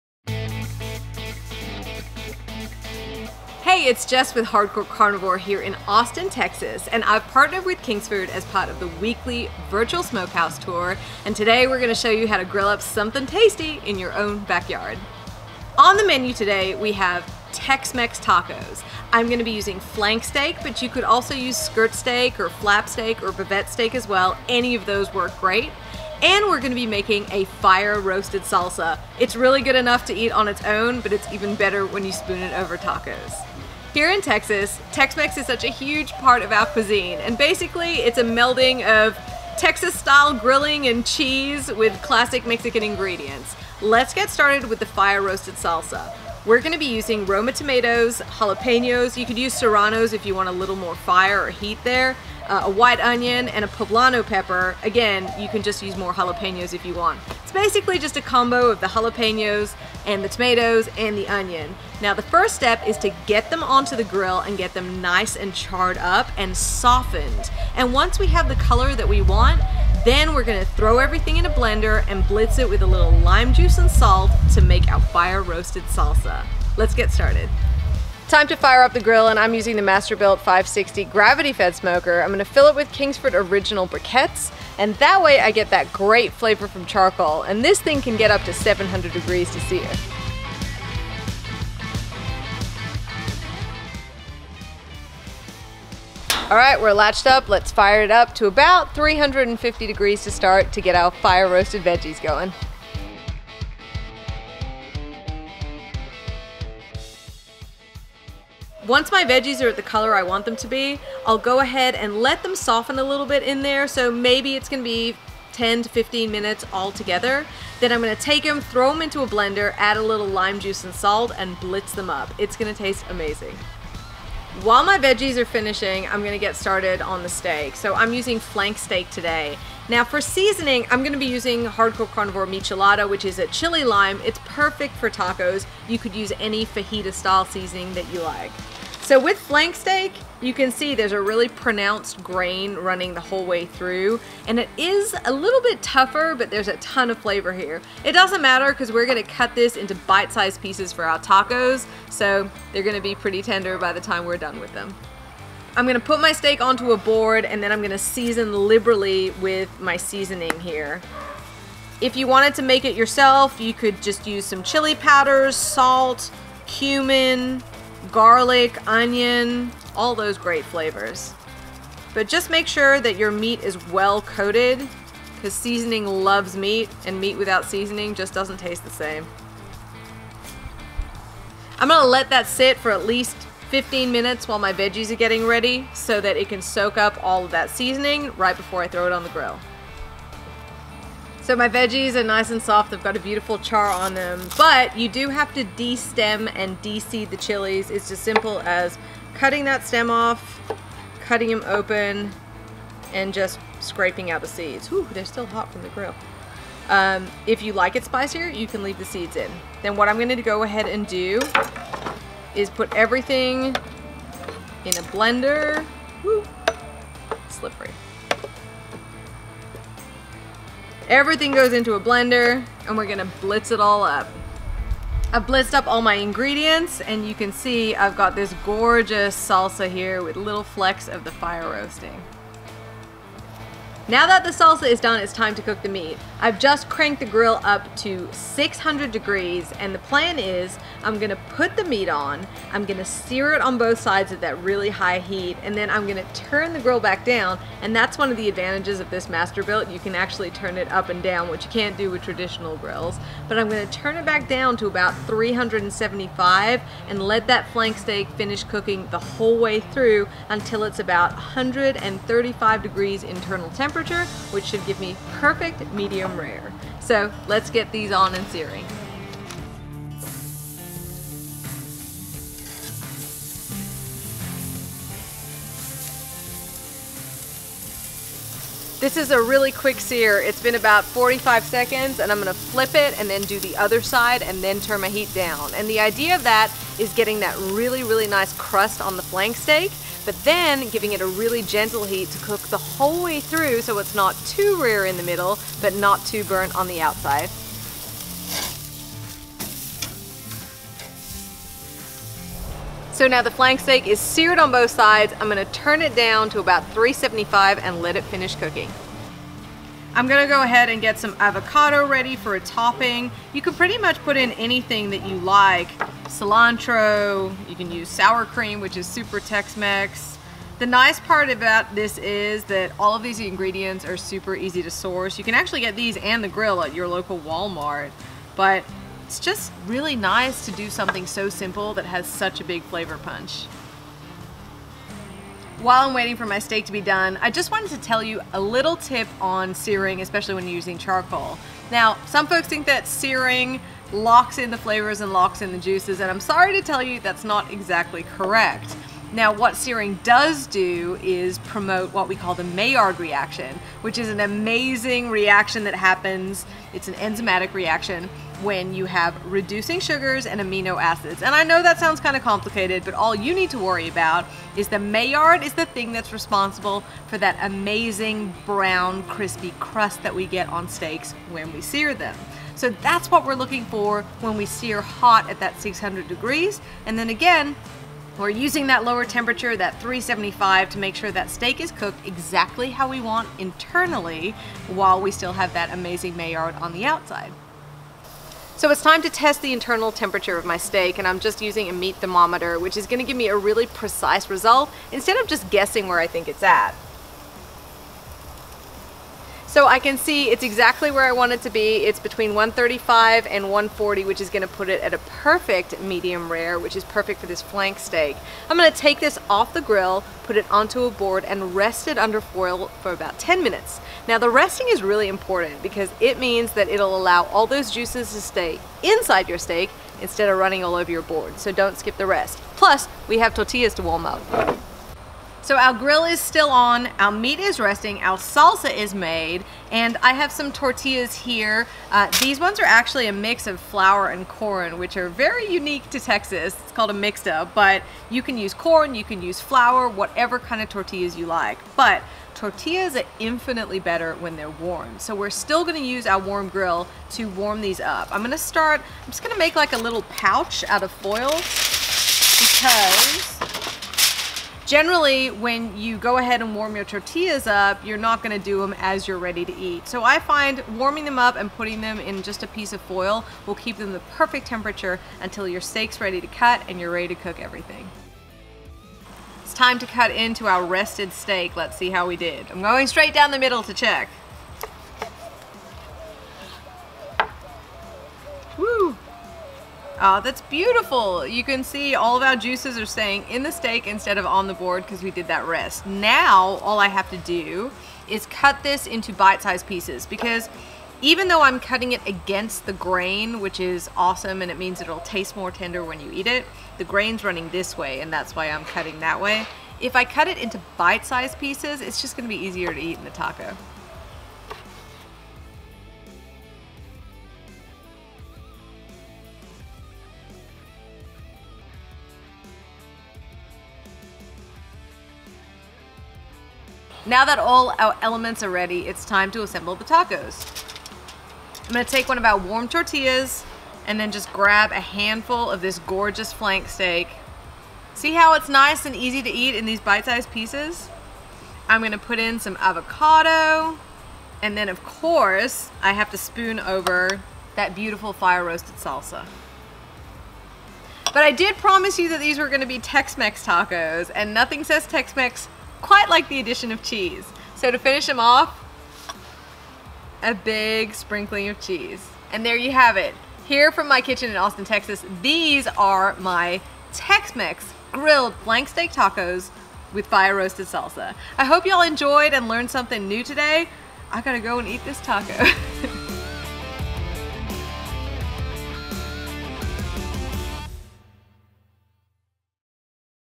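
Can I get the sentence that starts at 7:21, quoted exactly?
But tortillas are infinitely better when they're warm.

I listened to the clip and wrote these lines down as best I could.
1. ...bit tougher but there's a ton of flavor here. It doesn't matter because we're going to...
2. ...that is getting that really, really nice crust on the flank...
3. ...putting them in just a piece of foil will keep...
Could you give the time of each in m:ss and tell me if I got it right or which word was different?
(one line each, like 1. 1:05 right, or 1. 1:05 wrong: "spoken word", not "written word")
1. 2:25 right
2. 4:46 right
3. 7:41 right.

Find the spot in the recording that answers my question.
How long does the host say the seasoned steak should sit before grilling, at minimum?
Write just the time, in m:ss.
3:02.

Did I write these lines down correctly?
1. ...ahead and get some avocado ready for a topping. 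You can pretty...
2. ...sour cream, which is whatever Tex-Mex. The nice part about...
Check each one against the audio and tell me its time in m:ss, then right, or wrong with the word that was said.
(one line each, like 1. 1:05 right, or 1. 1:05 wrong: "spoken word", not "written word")
1. 5:10 right
2. 5:18 wrong: "super", not "whatever".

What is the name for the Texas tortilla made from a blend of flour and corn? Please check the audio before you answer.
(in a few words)
mixta.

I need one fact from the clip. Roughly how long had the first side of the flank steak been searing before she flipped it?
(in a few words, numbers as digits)
45 seconds.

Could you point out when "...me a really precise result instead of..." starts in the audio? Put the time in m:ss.
6:33.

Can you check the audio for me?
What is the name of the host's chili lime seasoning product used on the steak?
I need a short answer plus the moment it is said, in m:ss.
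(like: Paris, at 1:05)
Michelada, at 2:12.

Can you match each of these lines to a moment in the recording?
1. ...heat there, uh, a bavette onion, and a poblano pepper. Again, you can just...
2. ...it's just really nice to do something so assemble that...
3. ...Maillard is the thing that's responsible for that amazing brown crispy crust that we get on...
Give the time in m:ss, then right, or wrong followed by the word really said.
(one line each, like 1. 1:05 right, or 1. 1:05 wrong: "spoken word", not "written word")
1. 0:51 wrong: "white", not "bavette"
2. 5:29 wrong: "simple", not "assemble"
3. 6:04 right.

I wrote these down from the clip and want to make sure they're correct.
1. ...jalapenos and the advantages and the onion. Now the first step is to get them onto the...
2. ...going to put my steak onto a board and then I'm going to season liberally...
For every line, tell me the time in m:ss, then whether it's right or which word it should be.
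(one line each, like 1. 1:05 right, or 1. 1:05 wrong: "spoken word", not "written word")
1. 0:58 wrong: "tomatoes", not "advantages"
2. 2:35 right.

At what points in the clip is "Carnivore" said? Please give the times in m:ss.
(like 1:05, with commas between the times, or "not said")
0:04, 2:12.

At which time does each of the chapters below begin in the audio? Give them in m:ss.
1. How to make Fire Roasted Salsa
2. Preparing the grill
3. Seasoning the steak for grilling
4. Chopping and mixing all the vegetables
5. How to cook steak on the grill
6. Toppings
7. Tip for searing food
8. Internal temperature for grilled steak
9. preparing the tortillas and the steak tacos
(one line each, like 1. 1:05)
1. 0:42
2. 1:16
3. 2:04
4. 3:09
5. 3:55
6. 5:08
7. 5:34
8. 6:27
9. 7:04.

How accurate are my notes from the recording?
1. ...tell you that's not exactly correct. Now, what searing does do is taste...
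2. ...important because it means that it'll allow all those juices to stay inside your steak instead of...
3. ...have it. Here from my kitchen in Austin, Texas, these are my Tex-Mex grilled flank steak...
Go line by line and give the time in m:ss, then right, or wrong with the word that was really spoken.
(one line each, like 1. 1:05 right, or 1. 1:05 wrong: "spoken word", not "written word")
1. 5:46 wrong: "promote", not "taste"
2. 6:55 right
3. 9:12 right.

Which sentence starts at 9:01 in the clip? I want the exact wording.
But I did promise you that these were gonna be Tex-Mex tacos, and nothing says Tex-Mex quite like the addition of cheese.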